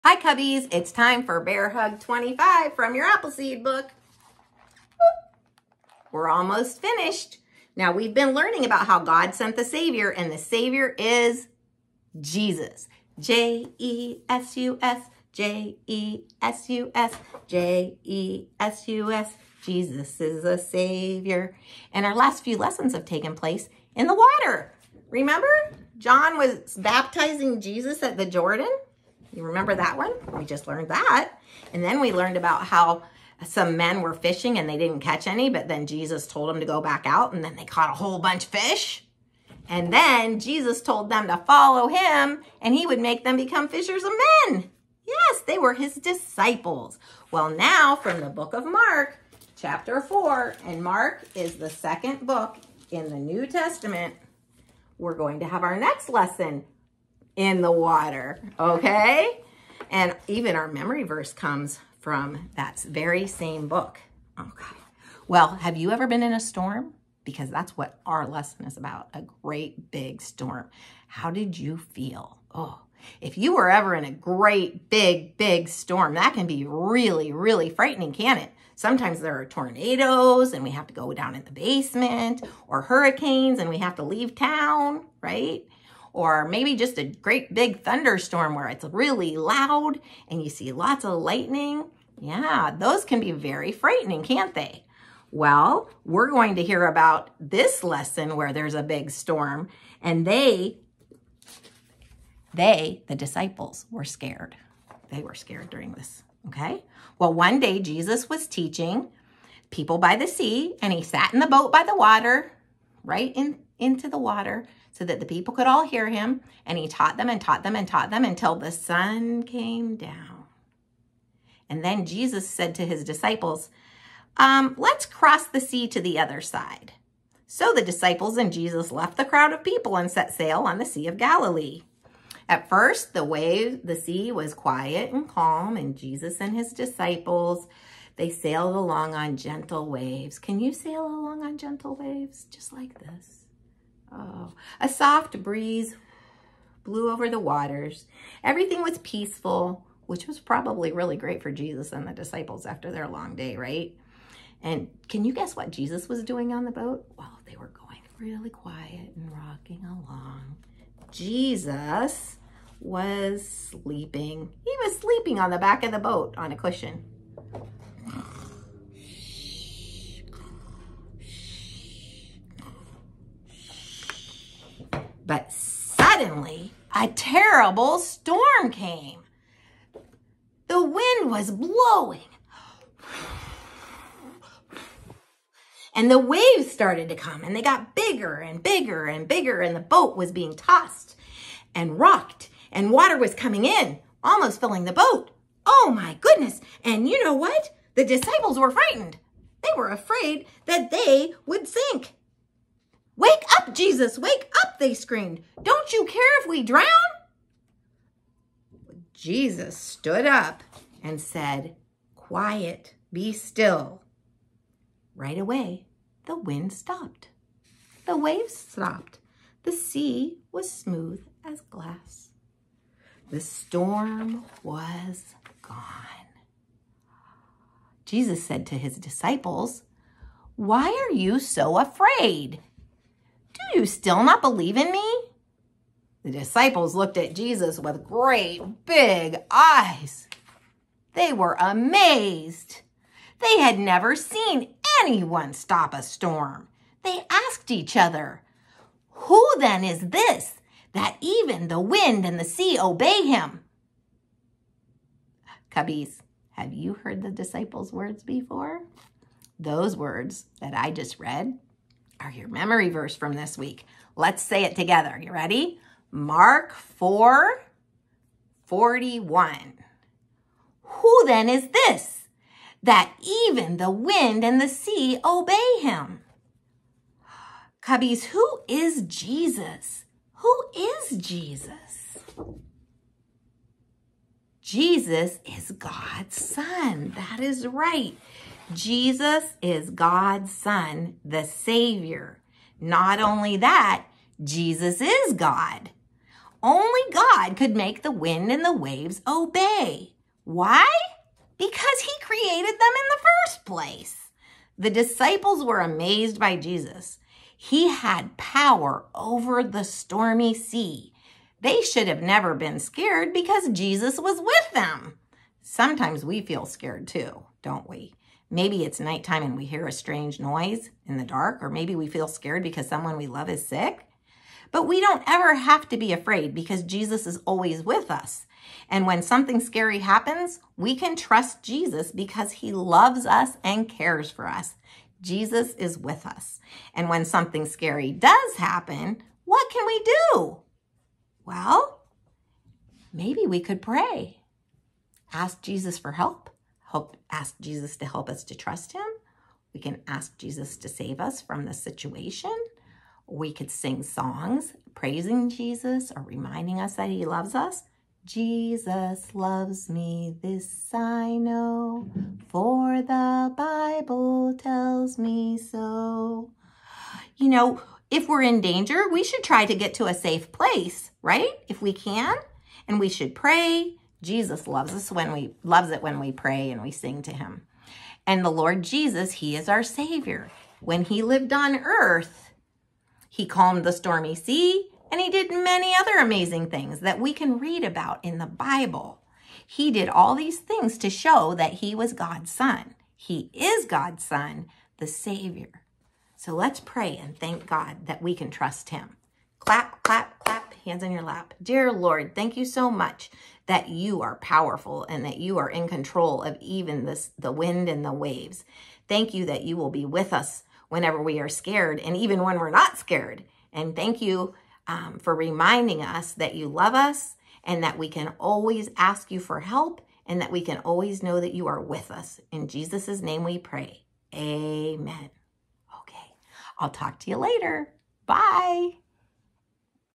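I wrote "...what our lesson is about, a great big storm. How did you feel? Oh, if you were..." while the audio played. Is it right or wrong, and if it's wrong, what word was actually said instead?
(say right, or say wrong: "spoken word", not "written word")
right.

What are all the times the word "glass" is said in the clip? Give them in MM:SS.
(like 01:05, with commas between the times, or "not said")
03:41.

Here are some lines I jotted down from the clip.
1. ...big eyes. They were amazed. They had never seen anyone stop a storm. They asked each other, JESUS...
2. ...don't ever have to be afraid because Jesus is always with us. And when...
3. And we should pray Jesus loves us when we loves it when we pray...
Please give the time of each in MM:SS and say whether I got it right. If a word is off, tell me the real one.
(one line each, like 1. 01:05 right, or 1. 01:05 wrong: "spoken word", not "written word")
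1. 03:58 wrong: "Who", not "JESUS"
2. 05:24 right
3. 06:12 right.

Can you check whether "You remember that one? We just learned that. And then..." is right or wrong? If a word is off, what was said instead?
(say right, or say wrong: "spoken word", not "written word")
right.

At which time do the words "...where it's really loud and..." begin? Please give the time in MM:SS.
01:28.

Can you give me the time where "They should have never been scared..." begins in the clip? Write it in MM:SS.
05:11.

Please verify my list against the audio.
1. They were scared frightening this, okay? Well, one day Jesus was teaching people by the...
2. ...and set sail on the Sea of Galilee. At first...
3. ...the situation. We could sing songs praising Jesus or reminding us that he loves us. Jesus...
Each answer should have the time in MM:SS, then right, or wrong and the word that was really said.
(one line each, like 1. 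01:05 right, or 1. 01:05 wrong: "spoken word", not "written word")
1. 01:45 wrong: "during", not "frightening"
2. 02:09 right
3. 05:51 right.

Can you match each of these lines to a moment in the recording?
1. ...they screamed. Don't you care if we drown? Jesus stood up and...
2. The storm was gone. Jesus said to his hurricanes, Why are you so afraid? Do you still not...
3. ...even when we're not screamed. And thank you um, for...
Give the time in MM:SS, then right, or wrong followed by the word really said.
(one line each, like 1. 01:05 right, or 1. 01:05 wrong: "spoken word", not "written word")
1. 03:24 right
2. 03:43 wrong: "disciples", not "hurricanes"
3. 06:52 wrong: "scared", not "screamed".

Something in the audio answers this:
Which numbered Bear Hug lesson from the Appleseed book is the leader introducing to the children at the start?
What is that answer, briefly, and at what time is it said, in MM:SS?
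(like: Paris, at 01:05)
25, at 00:01.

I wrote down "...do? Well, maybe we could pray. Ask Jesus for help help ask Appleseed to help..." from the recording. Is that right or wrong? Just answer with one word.
wrong.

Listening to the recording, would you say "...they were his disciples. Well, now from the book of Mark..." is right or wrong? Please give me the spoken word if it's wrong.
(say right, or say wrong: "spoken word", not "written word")
right.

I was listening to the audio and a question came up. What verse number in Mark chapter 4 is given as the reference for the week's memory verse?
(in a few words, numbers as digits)
41.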